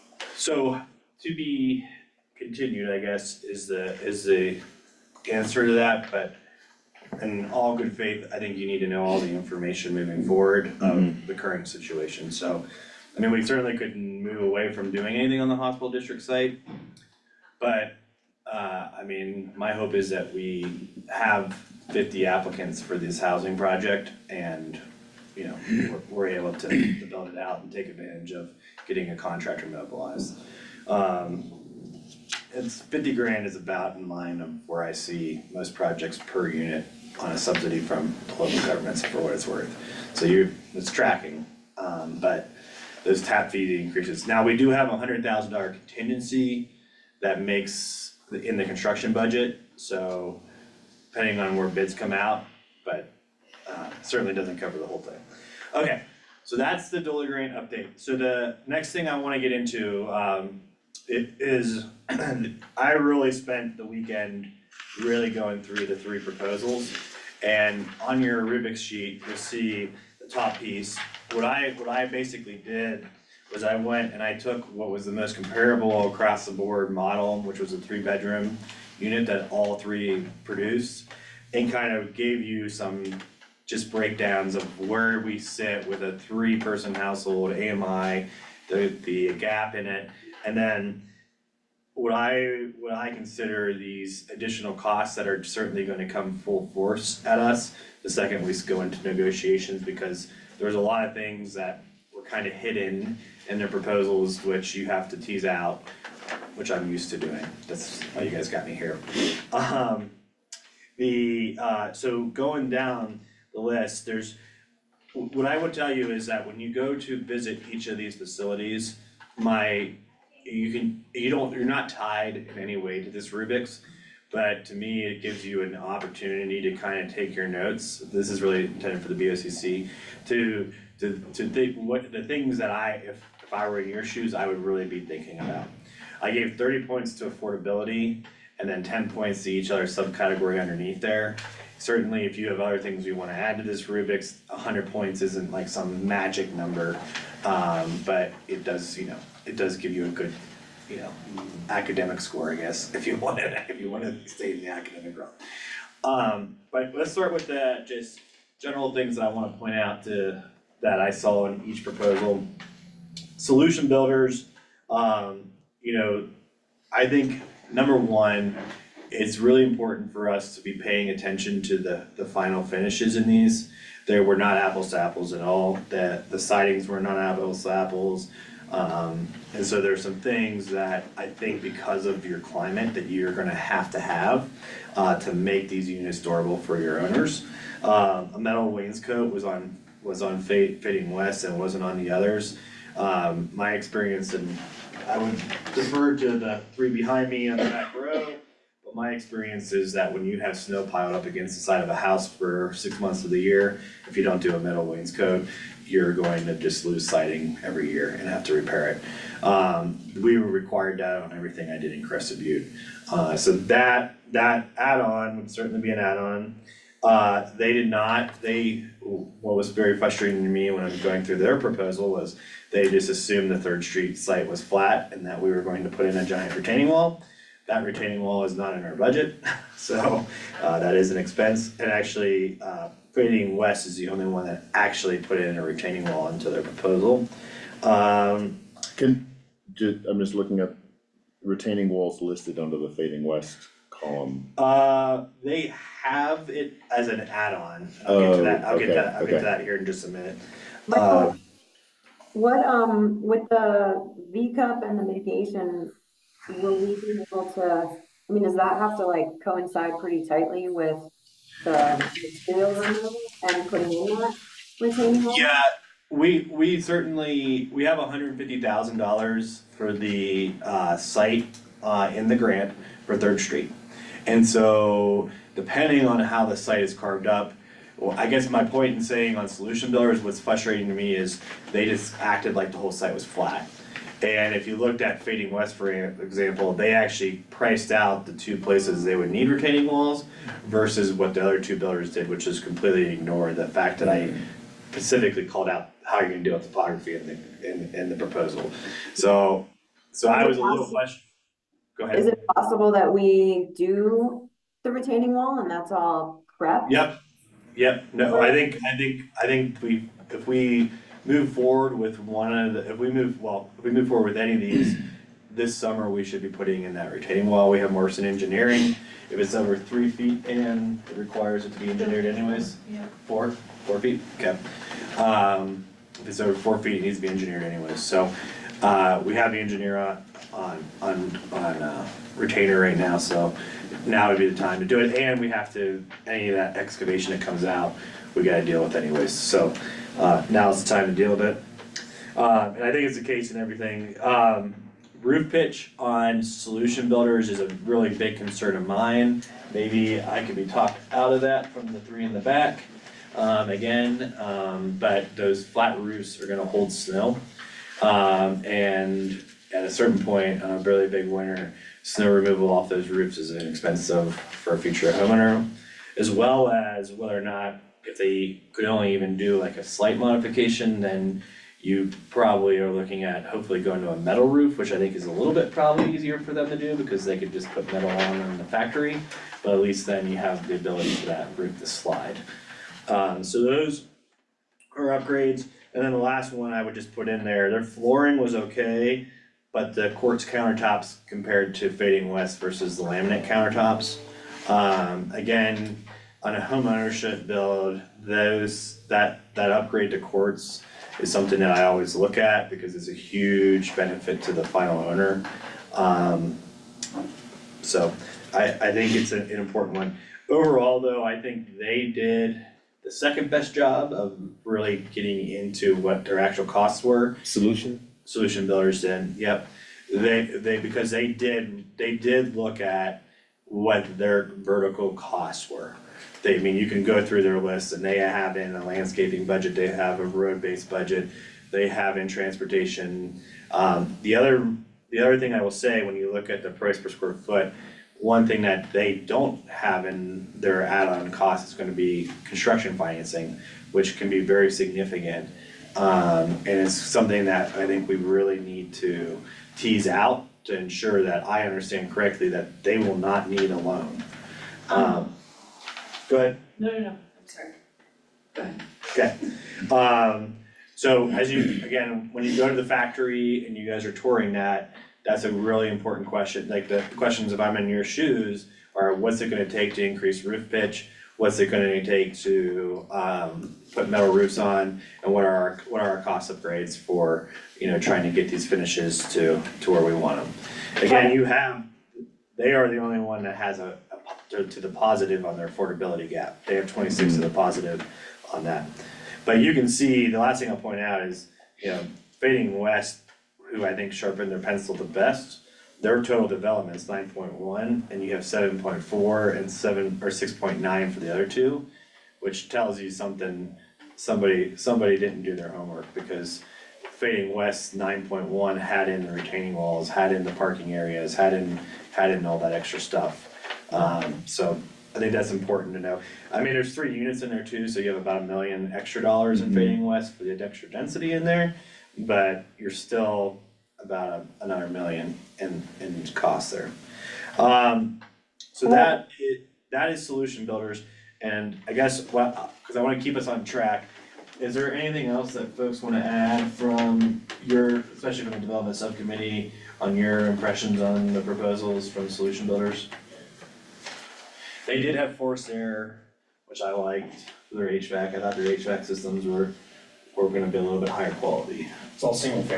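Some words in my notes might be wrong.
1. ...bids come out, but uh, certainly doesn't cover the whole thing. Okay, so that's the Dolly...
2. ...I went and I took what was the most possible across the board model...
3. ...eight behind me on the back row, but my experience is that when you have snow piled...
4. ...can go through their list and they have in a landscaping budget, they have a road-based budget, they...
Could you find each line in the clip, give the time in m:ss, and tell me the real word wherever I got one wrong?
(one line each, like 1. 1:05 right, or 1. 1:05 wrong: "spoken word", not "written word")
1. 0:51 right
2. 1:13 wrong: "comparable", not "possible"
3. 3:16 wrong: "three", not "eight"
4. 7:06 right.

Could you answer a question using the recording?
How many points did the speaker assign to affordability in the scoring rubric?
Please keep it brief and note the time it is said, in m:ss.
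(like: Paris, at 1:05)
30, at 2:16.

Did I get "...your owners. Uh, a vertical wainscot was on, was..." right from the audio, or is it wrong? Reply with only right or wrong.
wrong.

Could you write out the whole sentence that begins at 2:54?
They were not apples to apples at all, that the sightings were not apples to apples.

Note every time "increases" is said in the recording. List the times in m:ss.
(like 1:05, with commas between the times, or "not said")
0:43, 7:50.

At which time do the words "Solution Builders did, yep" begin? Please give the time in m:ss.
6:58.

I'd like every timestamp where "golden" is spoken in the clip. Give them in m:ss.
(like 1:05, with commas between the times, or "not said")
not said.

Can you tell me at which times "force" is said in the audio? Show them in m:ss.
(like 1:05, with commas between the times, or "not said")
1:36, 9:05.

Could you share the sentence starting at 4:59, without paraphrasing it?
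So, so I was a little question.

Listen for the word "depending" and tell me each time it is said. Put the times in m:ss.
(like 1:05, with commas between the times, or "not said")
0:51, 4:35.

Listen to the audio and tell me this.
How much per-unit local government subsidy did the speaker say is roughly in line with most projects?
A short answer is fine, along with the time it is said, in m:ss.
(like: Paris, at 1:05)
50 grand, at 0:32.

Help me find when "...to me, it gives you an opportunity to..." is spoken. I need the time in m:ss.
2:04.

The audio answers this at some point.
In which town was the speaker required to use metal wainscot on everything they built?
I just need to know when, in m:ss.
3:32.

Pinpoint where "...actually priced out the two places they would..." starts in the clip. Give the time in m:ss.
4:46.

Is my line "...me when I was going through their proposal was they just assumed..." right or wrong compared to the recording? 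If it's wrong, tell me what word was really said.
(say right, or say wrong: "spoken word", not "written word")
right.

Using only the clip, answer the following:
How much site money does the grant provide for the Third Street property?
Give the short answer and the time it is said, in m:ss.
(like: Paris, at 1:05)
$150,000, at 4:27.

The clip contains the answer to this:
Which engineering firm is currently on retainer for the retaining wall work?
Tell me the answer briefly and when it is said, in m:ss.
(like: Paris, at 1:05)
Morrison Engineering, at 5:17.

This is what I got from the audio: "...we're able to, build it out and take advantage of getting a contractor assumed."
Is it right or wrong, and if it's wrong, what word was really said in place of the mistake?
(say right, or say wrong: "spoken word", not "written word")
wrong: "mobilized", not "assumed".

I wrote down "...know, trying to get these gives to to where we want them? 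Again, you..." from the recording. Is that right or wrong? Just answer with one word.
wrong.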